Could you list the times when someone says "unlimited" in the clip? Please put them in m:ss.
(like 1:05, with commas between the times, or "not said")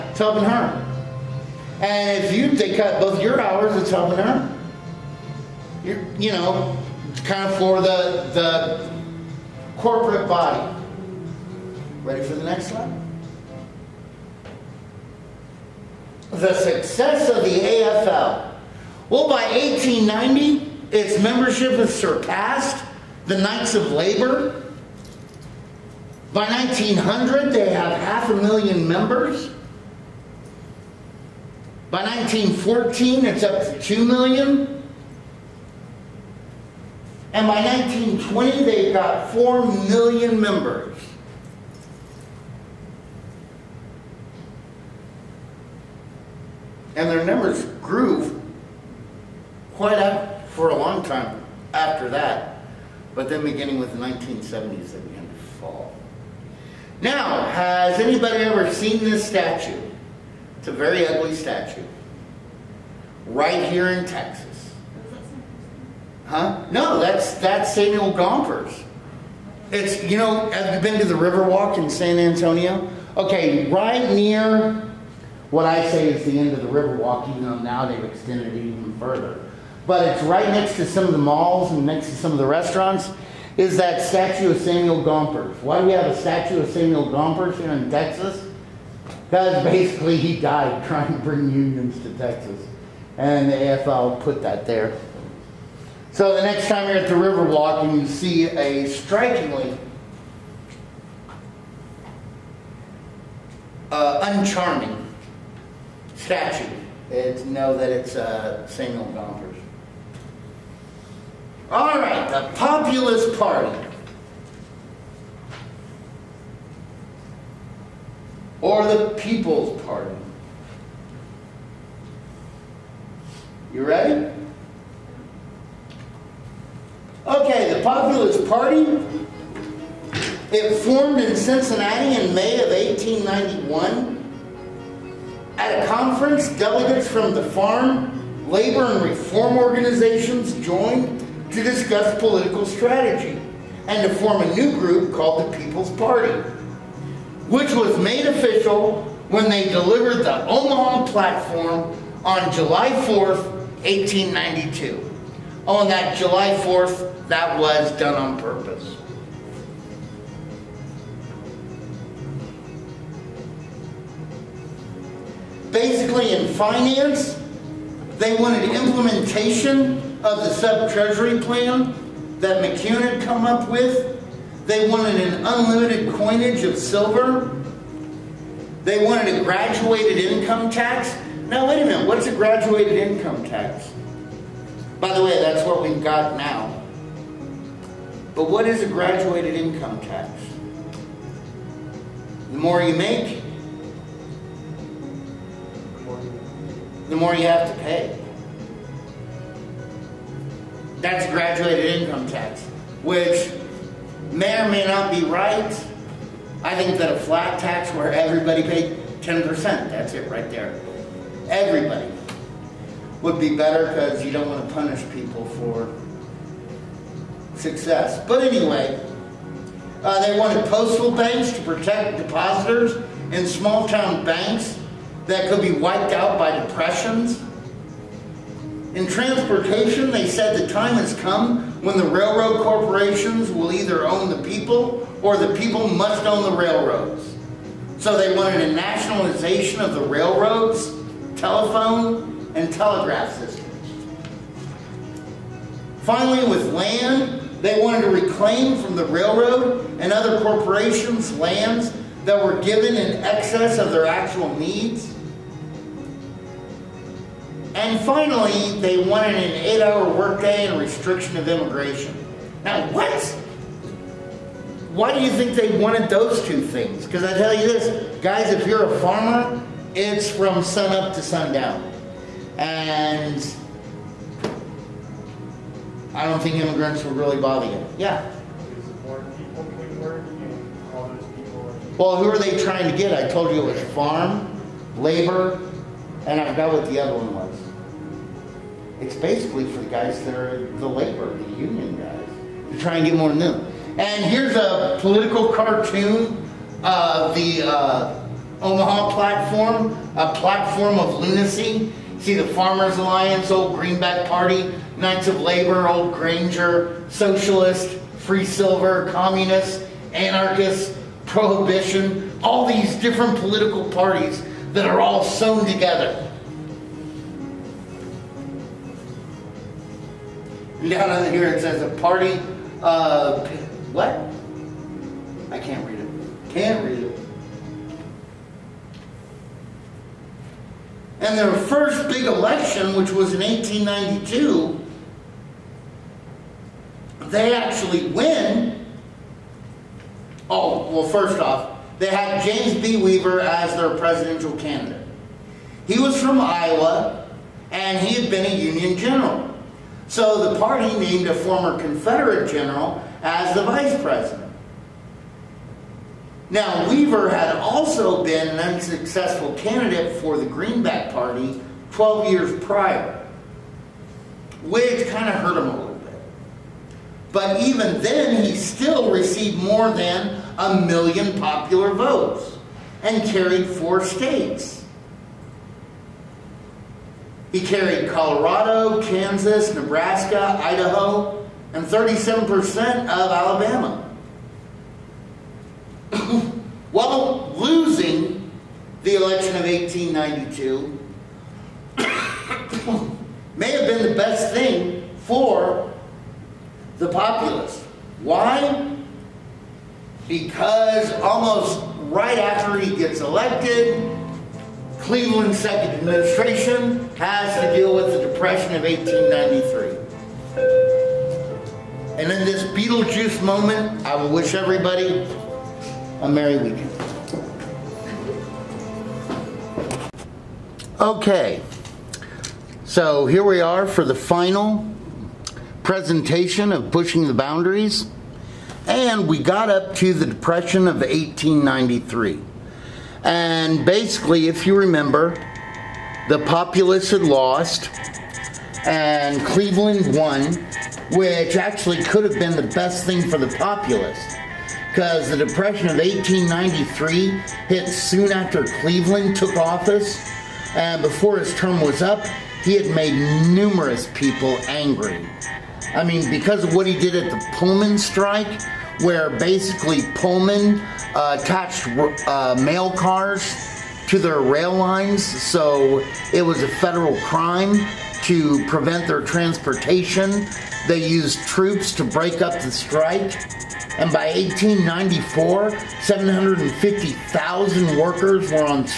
2:55.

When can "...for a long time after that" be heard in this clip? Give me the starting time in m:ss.
0:50.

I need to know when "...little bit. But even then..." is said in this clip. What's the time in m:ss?
6:05.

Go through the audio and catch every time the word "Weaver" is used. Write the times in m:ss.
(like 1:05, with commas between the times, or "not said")
5:42, 5:56.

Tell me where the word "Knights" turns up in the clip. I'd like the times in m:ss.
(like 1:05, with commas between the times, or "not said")
0:23, 5:04.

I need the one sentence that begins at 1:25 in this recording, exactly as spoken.
Why do we have a statue of Samuel Gompers here in Texas?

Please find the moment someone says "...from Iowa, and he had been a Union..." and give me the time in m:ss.
5:46.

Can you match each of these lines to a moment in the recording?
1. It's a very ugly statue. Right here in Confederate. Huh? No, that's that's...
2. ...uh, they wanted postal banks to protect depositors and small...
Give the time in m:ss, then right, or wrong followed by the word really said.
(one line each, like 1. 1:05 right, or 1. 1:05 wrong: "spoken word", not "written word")
1. 1:00 wrong: "Texas", not "Confederate"
2. 3:40 right.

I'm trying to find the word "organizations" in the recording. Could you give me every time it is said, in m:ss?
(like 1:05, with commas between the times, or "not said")
2:19.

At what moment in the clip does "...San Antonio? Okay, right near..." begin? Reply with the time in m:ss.
1:11.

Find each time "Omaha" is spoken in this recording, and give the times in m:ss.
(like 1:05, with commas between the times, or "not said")
2:30, 4:58.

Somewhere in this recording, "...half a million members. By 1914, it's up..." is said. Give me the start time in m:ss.
0:27.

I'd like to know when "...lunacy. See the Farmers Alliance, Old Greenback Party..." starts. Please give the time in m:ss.
5:01.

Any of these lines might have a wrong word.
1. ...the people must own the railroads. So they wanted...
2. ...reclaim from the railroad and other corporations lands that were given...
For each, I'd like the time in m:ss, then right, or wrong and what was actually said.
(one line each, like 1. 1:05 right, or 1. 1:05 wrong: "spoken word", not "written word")
1. 3:55 right
2. 4:08 right.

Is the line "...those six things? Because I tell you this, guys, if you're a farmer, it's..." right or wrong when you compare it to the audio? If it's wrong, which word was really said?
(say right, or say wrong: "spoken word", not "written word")
wrong: "two", not "six".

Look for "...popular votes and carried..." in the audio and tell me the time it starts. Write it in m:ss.
6:11.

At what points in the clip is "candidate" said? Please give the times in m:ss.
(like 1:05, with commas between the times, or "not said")
5:44, 5:59.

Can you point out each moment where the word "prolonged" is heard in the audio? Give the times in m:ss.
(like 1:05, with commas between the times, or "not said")
not said.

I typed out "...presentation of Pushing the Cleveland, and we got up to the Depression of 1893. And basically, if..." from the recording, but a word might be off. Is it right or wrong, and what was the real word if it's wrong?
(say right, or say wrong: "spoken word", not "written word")
wrong: "Boundaries", not "Cleveland".